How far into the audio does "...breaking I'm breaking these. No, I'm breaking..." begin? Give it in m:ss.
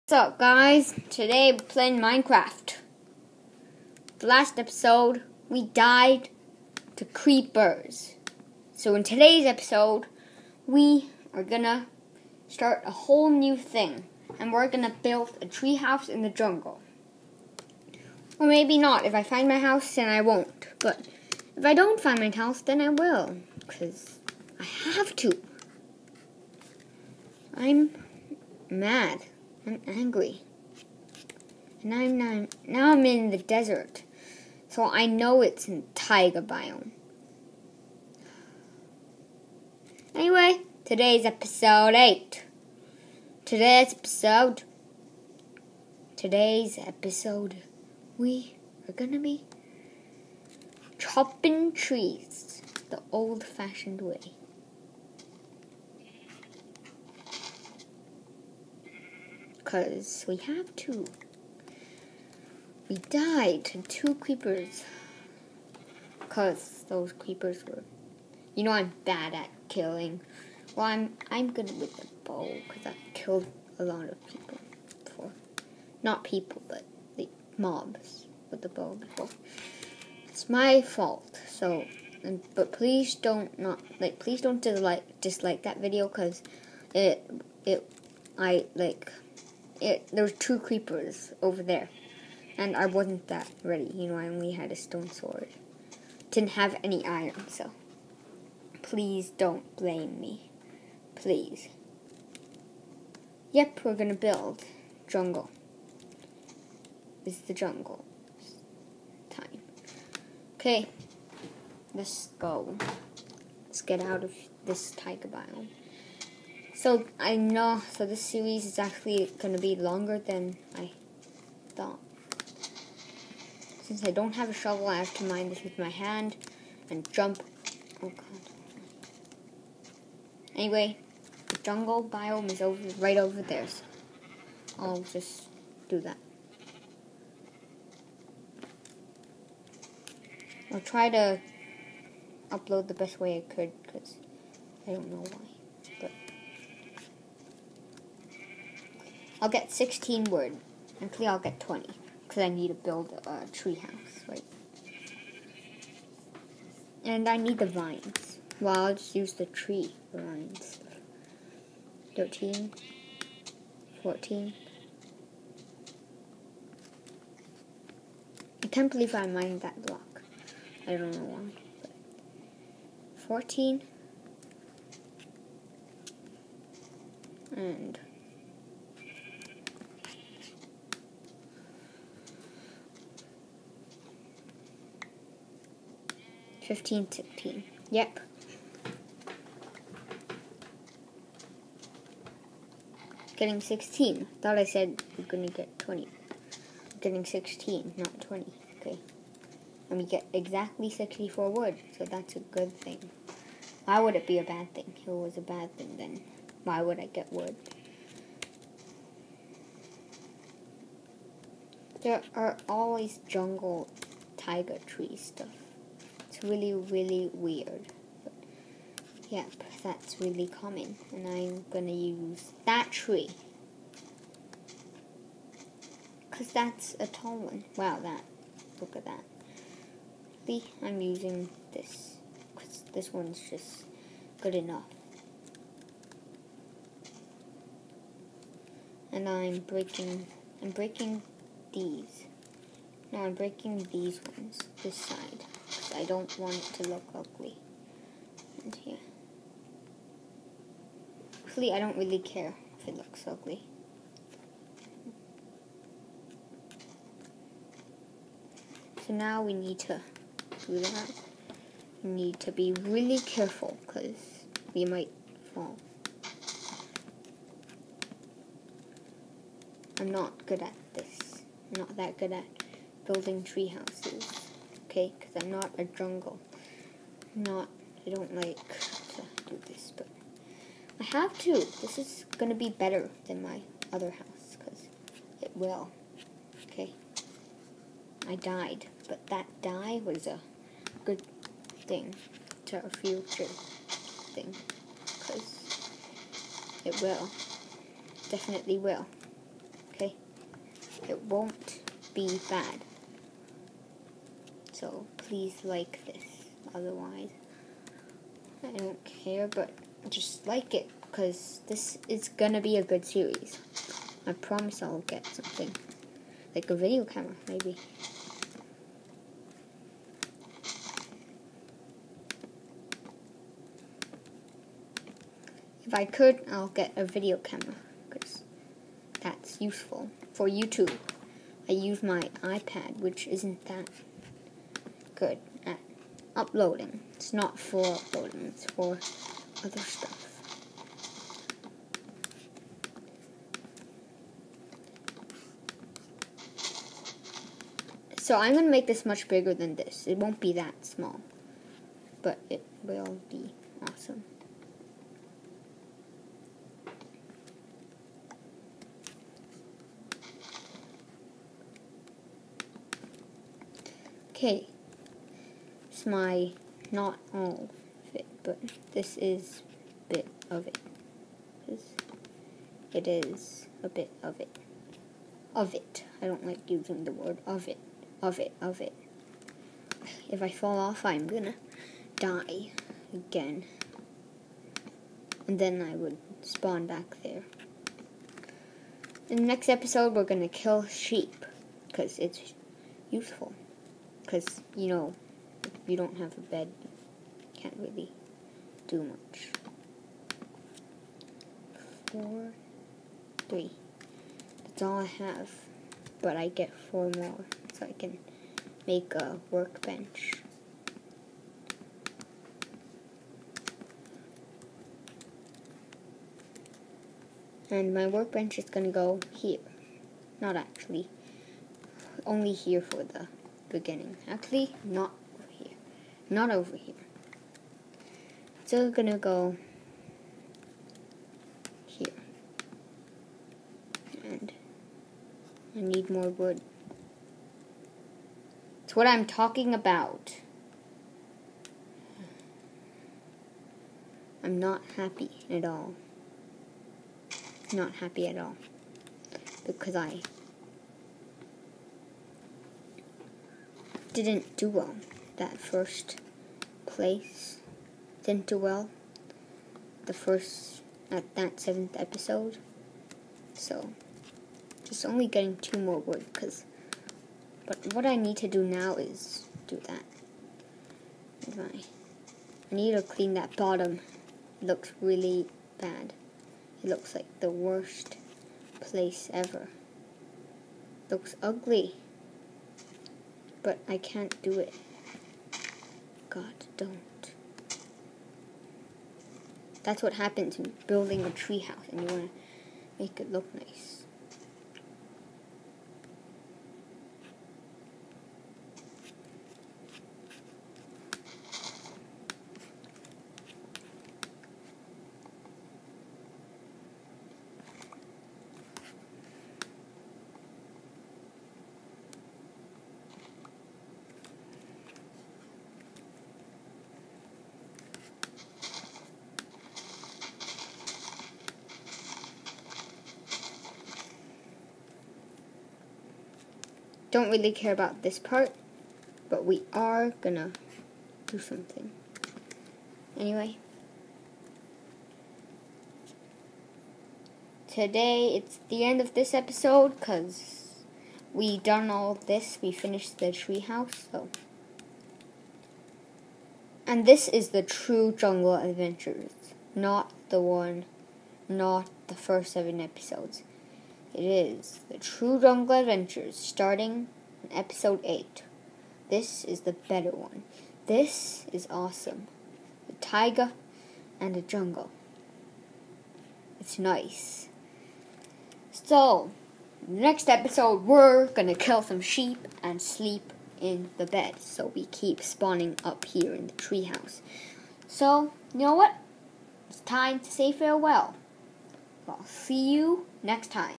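3:59.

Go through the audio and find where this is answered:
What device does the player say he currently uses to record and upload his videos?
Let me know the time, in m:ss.
5:32.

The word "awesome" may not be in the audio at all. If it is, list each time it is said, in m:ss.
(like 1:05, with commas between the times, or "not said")
5:53, 9:21.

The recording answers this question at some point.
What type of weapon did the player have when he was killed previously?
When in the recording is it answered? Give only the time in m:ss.
1:34.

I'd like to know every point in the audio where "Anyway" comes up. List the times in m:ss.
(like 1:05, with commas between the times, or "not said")
0:40, 2:10, 8:53.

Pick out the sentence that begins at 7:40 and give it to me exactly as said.
the first, at that seventh episode.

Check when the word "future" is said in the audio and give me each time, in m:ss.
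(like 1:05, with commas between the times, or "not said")
4:52.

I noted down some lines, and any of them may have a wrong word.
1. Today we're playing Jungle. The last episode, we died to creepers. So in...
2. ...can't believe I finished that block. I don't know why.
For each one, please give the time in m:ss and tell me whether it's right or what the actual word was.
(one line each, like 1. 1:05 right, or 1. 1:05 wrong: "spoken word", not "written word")
1. 0:01 wrong: "Minecraft", not "Jungle"
2. 2:48 wrong: "mined", not "finished".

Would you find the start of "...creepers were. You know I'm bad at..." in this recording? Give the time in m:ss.
1:07.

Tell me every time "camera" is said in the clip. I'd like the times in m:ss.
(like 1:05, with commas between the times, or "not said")
5:17, 5:27.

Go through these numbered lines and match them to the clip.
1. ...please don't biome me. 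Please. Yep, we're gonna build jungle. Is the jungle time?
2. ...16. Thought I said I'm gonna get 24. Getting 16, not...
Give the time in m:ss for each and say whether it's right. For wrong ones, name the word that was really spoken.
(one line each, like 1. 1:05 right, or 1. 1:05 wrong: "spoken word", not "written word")
1. 1:38 wrong: "blame", not "biome"
2. 3:13 wrong: "20", not "24".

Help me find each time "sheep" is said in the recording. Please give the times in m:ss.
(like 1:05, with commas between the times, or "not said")
6:30, 9:32.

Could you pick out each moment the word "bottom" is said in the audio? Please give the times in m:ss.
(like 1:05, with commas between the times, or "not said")
7:53.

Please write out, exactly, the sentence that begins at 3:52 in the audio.
Because this one's just good enough.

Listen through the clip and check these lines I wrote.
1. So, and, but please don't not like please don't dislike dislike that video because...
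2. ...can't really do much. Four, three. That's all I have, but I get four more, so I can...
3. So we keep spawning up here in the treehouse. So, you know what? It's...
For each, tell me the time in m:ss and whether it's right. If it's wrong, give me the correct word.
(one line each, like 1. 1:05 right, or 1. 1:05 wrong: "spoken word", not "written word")
1. 1:21 right
2. 6:37 right
3. 9:34 right.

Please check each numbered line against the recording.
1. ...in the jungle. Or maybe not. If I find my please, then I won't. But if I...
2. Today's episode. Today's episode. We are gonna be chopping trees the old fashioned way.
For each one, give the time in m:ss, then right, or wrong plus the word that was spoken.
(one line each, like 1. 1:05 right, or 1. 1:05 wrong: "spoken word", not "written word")
1. 0:16 wrong: "house", not "please"
2. 0:43 right.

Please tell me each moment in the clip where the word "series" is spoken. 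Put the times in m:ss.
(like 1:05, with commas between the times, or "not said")
1:58, 5:13.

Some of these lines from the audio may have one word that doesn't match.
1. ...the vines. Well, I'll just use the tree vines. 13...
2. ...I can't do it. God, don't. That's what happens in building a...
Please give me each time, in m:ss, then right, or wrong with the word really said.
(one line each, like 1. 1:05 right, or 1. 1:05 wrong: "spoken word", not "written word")
1. 2:37 right
2. 8:03 right.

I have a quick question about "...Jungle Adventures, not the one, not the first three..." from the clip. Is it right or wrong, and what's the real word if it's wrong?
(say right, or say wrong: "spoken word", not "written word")
wrong: "seven", not "three".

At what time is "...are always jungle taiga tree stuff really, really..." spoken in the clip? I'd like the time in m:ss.
3:32.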